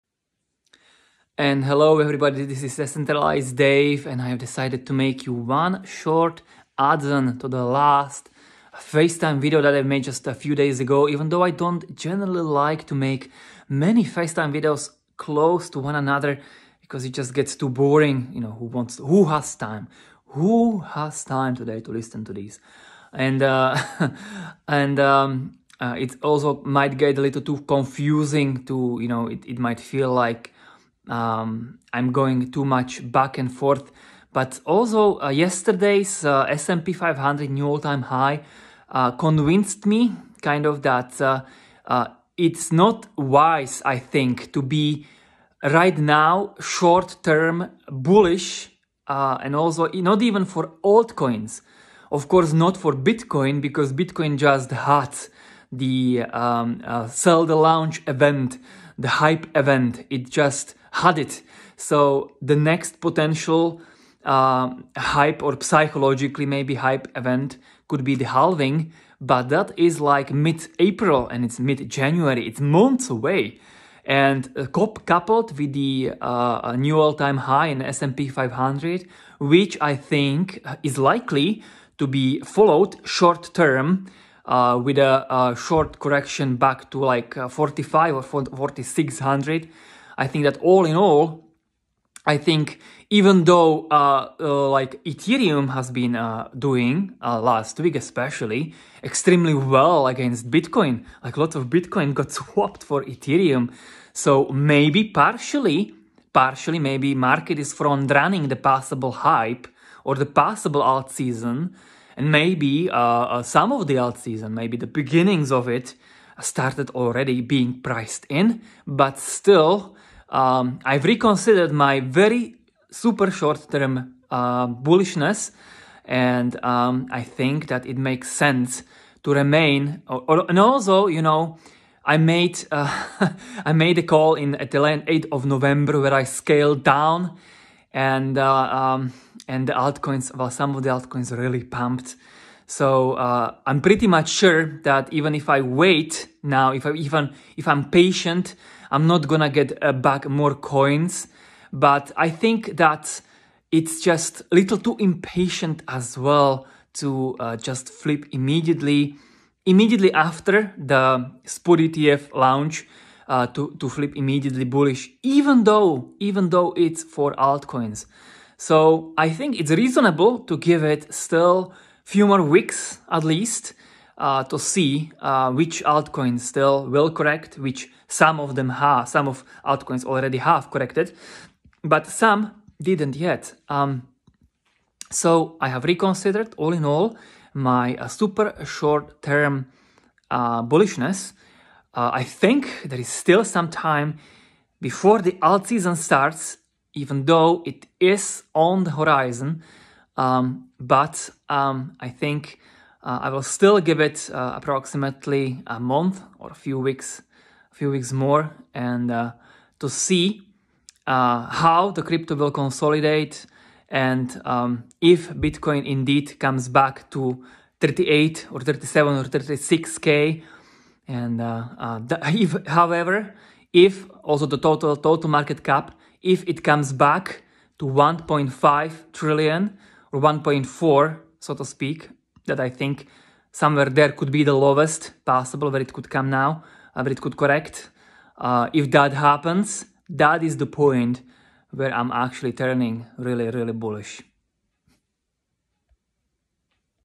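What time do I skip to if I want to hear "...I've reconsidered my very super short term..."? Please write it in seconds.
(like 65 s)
120 s.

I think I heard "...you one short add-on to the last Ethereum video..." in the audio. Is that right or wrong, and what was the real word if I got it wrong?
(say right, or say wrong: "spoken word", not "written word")
wrong: "FaceTime", not "Ethereum".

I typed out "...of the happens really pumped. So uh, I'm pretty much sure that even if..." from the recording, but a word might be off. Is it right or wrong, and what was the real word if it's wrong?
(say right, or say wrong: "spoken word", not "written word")
wrong: "altcoins", not "happens".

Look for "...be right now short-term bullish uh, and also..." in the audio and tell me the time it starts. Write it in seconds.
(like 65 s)
44 s.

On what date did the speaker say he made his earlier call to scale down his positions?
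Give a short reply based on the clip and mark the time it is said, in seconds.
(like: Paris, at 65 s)
8th of November, at 135 s.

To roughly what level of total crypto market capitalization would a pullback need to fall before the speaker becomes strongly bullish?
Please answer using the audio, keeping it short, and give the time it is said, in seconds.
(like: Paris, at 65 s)
1.5 trillion, at 227 s.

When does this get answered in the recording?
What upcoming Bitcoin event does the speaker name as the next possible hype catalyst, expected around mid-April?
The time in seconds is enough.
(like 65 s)
68 s.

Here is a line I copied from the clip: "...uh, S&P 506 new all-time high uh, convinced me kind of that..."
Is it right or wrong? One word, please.
wrong.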